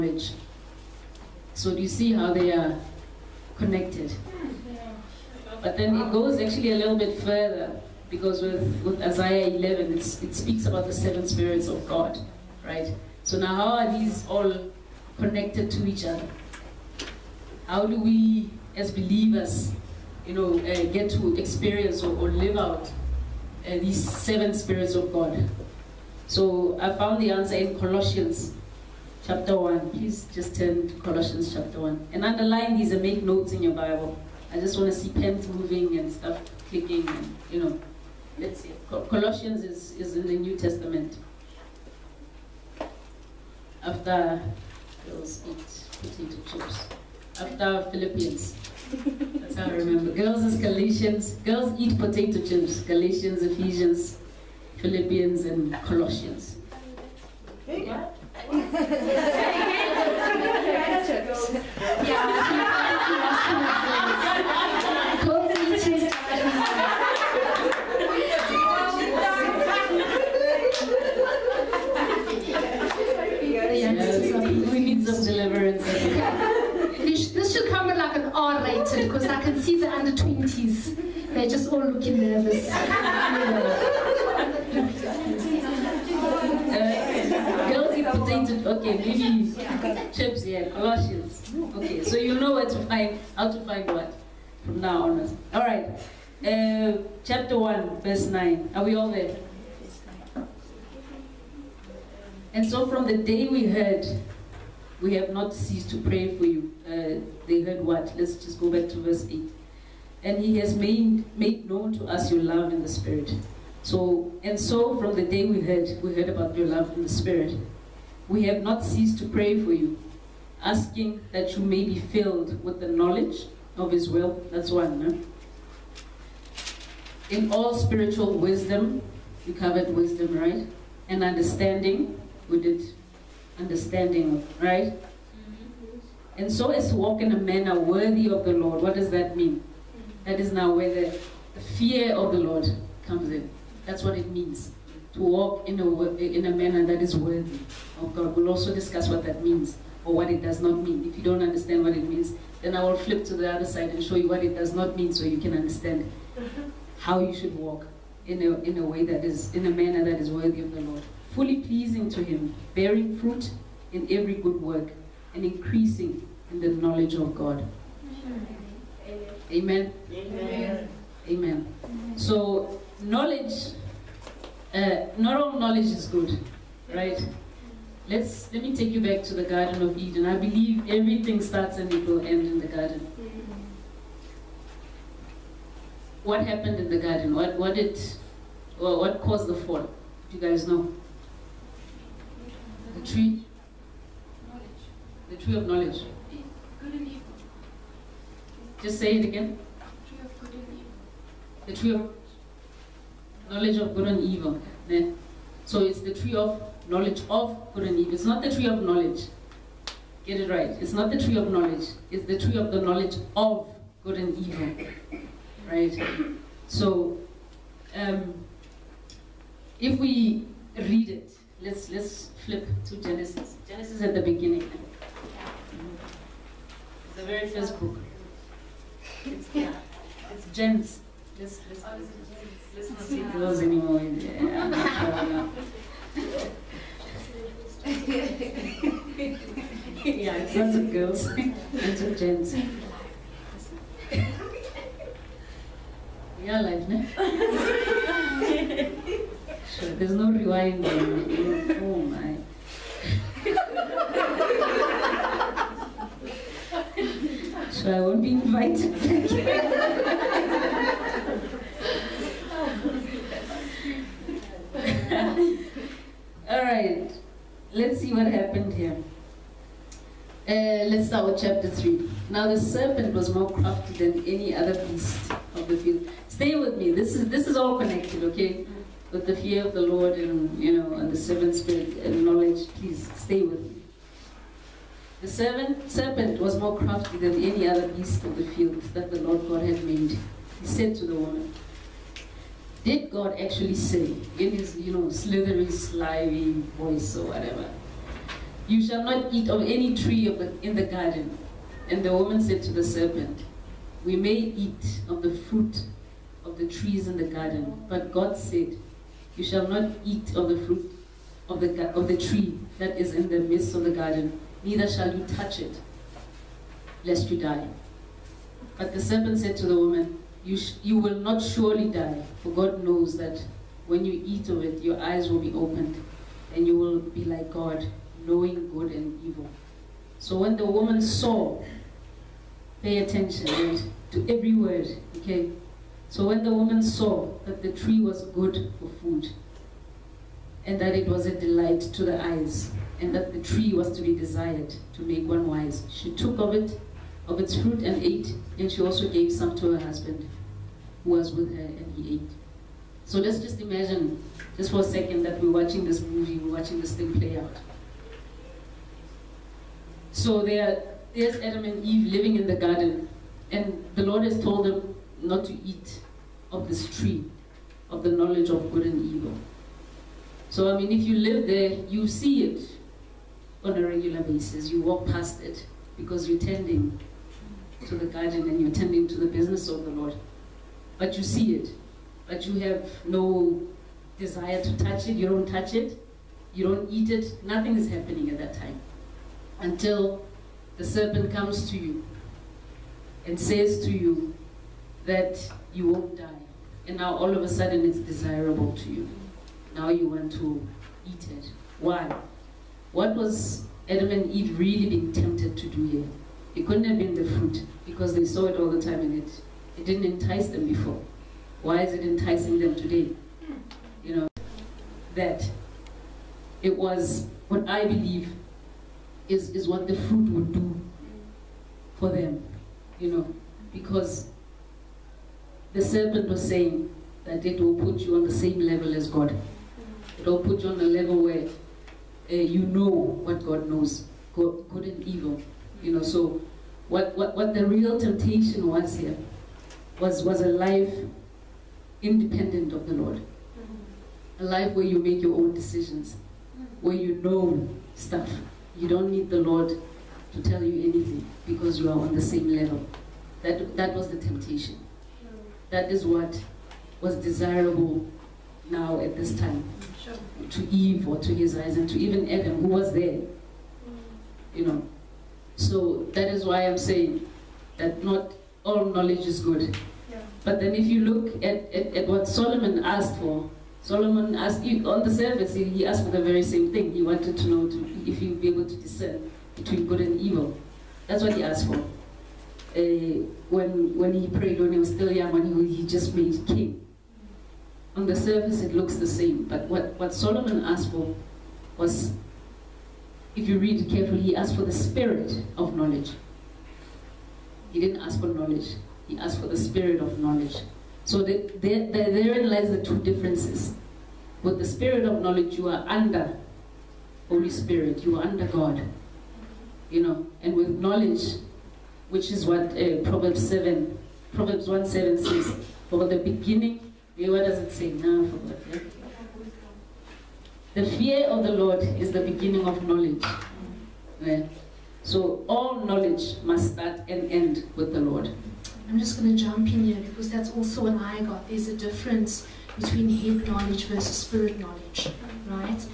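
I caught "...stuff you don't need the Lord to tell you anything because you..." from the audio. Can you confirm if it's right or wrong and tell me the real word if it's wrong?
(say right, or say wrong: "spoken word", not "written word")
right.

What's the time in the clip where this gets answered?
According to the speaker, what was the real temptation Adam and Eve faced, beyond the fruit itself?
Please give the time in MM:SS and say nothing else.
07:20.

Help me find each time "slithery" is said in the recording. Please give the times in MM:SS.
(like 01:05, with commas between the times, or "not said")
04:55.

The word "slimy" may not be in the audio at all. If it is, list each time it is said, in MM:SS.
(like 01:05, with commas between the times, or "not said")
04:55.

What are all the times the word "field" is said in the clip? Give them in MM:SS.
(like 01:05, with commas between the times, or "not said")
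04:35, 04:48.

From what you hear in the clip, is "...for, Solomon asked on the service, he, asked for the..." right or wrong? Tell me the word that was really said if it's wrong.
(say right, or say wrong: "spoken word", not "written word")
right.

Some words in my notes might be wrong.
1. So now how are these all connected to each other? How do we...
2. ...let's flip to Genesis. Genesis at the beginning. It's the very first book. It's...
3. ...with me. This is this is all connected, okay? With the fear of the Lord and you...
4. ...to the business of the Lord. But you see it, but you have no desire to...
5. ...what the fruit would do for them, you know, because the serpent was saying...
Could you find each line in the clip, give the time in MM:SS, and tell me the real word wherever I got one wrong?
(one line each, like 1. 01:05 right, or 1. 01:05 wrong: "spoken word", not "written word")
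1. 00:13 right
2. 03:41 right
3. 04:36 right
4. 06:19 right
5. 06:59 right.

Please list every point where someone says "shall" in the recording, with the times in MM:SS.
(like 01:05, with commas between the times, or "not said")
04:58, 05:09, 05:14.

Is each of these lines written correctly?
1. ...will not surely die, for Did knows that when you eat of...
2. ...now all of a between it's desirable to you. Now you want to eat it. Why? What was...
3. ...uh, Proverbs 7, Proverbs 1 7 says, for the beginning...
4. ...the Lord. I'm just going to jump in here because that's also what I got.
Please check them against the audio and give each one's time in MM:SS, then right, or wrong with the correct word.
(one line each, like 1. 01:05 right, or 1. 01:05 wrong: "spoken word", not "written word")
1. 05:20 wrong: "God", not "Did"
2. 06:36 wrong: "sudden", not "between"
3. 08:32 right
4. 08:47 right.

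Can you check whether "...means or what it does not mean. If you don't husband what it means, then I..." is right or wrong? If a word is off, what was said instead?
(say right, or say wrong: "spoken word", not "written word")
wrong: "understand", not "husband".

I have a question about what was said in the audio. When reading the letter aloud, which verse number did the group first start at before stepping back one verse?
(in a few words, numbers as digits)
9.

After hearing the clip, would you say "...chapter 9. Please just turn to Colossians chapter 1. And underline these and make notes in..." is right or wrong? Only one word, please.
wrong.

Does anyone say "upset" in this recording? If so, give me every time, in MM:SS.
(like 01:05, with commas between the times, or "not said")
not said.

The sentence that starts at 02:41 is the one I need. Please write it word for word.
Fully pleasing to Him, bearing fruit in every good work, and increasing in the knowledge of God.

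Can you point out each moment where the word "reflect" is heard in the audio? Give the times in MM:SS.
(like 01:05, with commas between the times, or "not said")
not said.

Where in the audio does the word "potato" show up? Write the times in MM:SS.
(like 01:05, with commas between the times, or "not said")
00:46, 00:51.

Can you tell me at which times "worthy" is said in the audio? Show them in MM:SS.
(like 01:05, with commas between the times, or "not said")
02:17, 02:27, 02:40.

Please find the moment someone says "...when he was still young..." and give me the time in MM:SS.
08:04.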